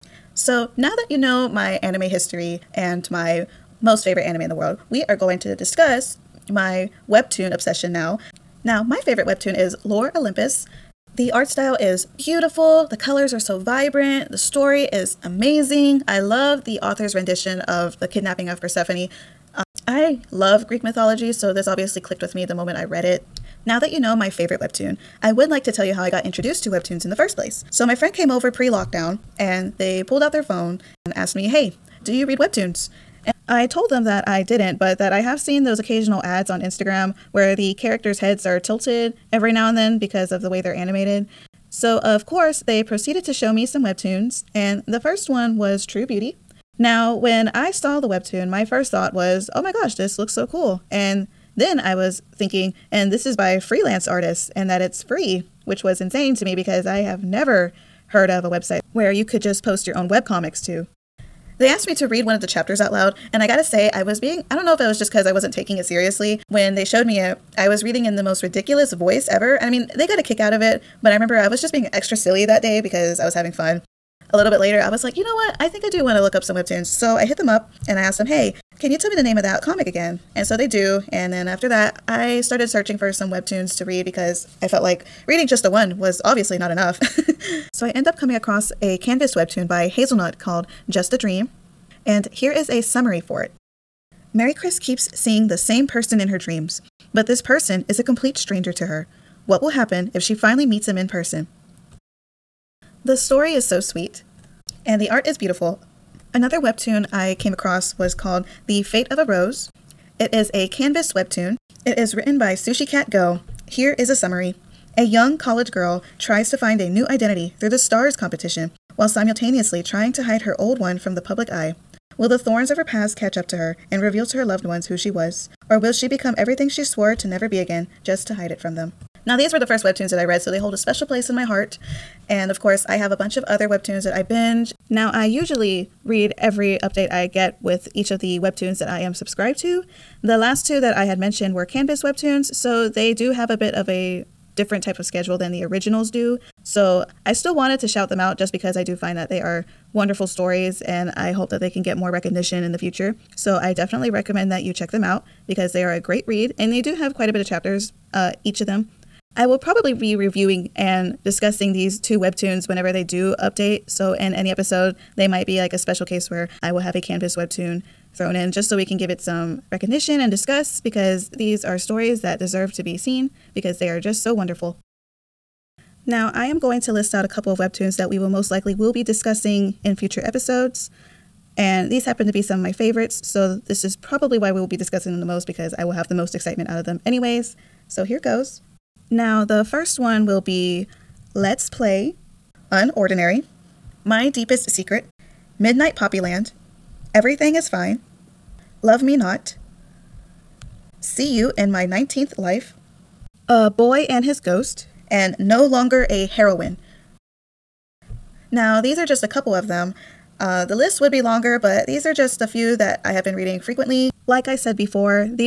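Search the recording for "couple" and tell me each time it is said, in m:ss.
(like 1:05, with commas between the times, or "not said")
2:57, 3:29.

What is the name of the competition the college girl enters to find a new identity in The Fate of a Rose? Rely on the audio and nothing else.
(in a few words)
STARS.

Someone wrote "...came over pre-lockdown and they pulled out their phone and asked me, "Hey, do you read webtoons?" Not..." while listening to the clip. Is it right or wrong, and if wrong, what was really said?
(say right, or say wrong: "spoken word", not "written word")
wrong: "And", not "Not".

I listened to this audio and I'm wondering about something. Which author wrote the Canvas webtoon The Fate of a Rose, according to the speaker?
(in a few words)
Sushi Cat Go.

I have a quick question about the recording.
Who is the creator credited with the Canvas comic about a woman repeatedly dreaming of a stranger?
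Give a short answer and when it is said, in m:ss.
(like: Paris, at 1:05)
Hazelnut, at 1:29.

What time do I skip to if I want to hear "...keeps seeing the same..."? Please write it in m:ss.
1:34.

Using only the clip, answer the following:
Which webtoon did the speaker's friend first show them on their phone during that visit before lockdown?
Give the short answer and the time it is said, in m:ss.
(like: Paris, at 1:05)
True Beauty, at 0:45.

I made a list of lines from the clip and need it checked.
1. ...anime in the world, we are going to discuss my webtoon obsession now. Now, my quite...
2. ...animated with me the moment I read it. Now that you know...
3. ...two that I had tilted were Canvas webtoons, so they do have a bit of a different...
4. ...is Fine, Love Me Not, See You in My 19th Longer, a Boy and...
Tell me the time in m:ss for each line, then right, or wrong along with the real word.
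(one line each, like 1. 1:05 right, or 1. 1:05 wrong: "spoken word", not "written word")
1. 0:04 wrong: "favorite", not "quite"
2. 0:21 wrong: "clicked", not "animated"
3. 2:20 wrong: "mentioned", not "tilted"
4. 3:17 wrong: "Life", not "Longer".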